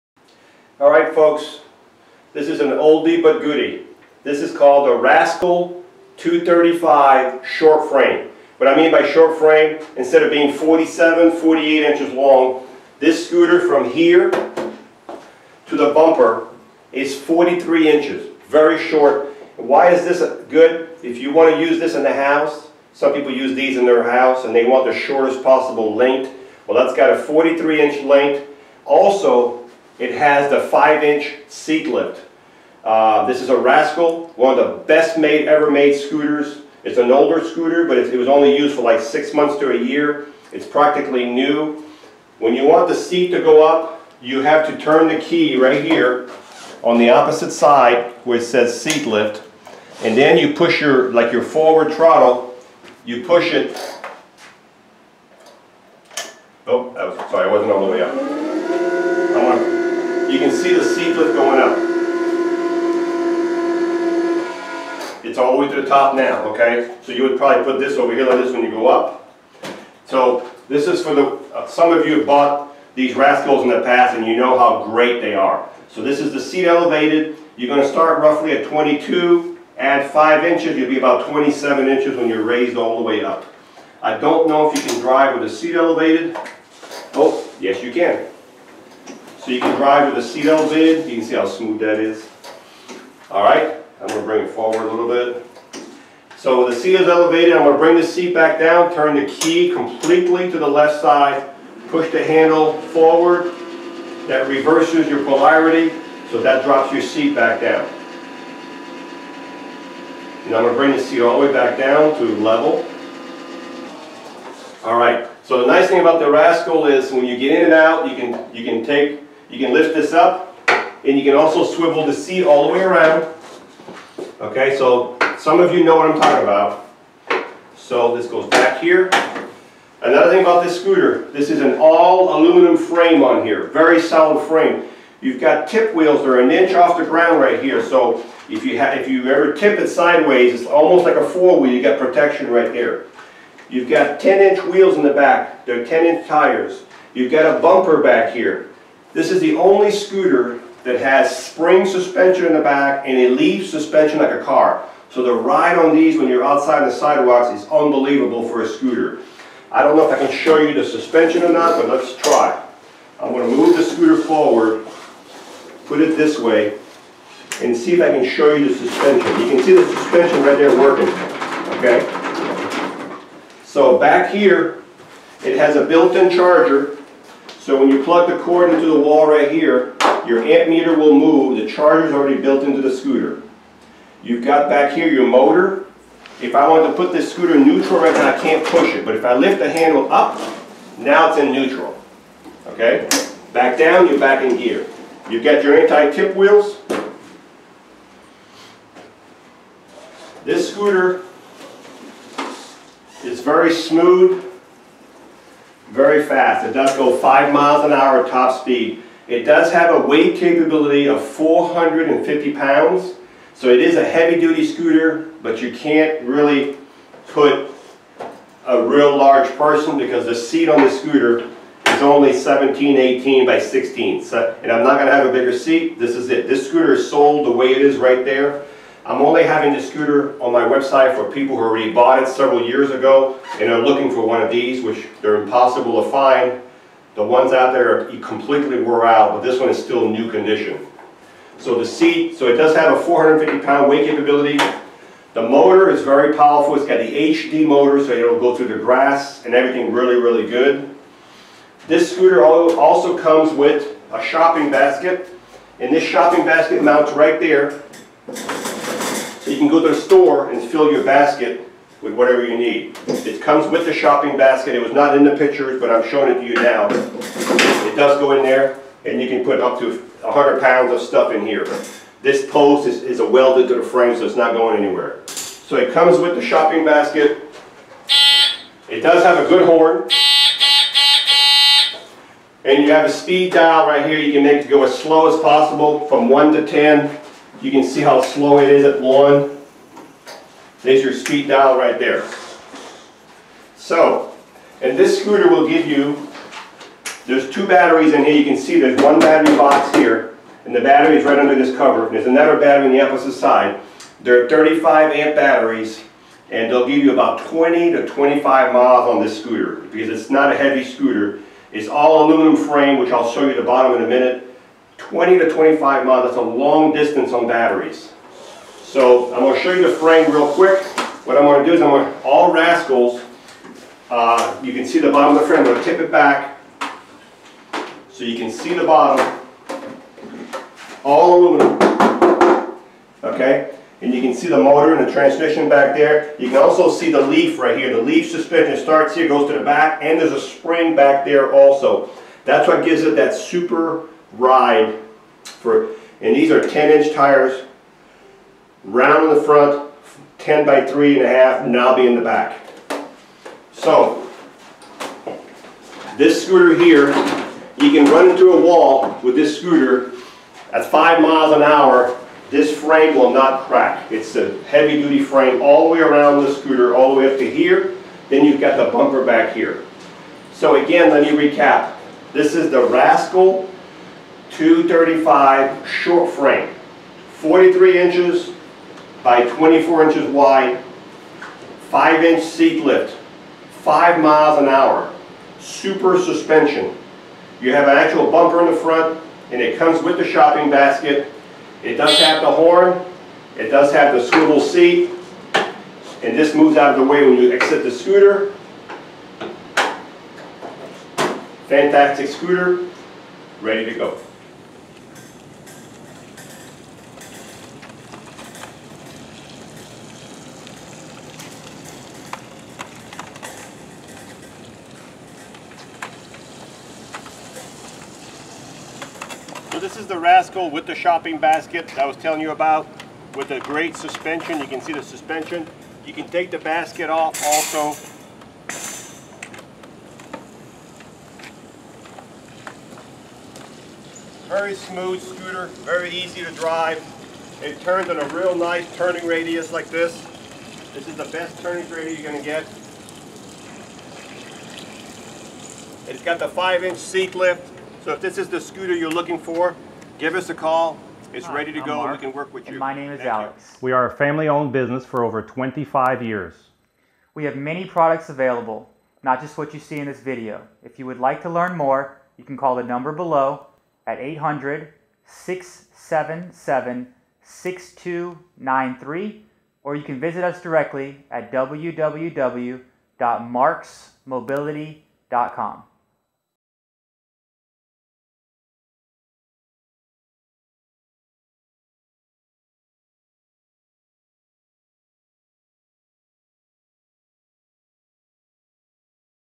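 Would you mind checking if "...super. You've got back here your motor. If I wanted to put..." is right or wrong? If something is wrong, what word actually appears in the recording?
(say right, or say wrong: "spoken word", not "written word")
wrong: "scooter", not "super".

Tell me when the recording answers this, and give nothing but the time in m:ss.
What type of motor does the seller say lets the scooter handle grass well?
4:07.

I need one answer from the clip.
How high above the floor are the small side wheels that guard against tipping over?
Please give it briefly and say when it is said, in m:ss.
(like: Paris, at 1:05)
an inch, at 2:16.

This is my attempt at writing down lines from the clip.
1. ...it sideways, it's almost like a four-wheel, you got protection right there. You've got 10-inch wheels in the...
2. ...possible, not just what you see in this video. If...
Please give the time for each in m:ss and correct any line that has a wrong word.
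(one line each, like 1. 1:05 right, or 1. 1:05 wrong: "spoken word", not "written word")
1. 2:19 right
2. 7:38 wrong: "available", not "possible".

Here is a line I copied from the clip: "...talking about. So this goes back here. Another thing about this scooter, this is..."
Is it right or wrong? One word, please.
right.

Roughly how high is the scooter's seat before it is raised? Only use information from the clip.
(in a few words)
22.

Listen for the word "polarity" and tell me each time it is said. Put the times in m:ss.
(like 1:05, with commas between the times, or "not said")
1:45.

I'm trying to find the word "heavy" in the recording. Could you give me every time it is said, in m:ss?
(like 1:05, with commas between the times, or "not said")
3:34, 5:10, 6:04.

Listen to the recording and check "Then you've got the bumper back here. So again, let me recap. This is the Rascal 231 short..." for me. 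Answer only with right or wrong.
wrong.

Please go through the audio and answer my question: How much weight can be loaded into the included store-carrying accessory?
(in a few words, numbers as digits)
100 pounds.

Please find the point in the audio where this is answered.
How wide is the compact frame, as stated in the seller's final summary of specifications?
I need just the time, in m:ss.
6:19.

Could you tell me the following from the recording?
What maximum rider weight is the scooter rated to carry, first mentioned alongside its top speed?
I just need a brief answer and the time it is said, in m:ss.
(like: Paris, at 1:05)
450 pounds, at 3:31.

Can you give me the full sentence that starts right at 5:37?
The leaf suspension starts here, goes to the back, and there's a spring back there also.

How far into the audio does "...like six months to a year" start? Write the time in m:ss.
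0:38.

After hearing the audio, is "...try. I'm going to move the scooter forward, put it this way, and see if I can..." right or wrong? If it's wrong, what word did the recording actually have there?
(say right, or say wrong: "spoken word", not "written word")
right.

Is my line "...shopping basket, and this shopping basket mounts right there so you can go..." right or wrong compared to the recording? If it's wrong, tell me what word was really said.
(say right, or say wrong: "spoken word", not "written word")
right.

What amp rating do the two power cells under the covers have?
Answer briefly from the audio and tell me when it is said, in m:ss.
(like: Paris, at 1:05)
35 amp, at 5:04.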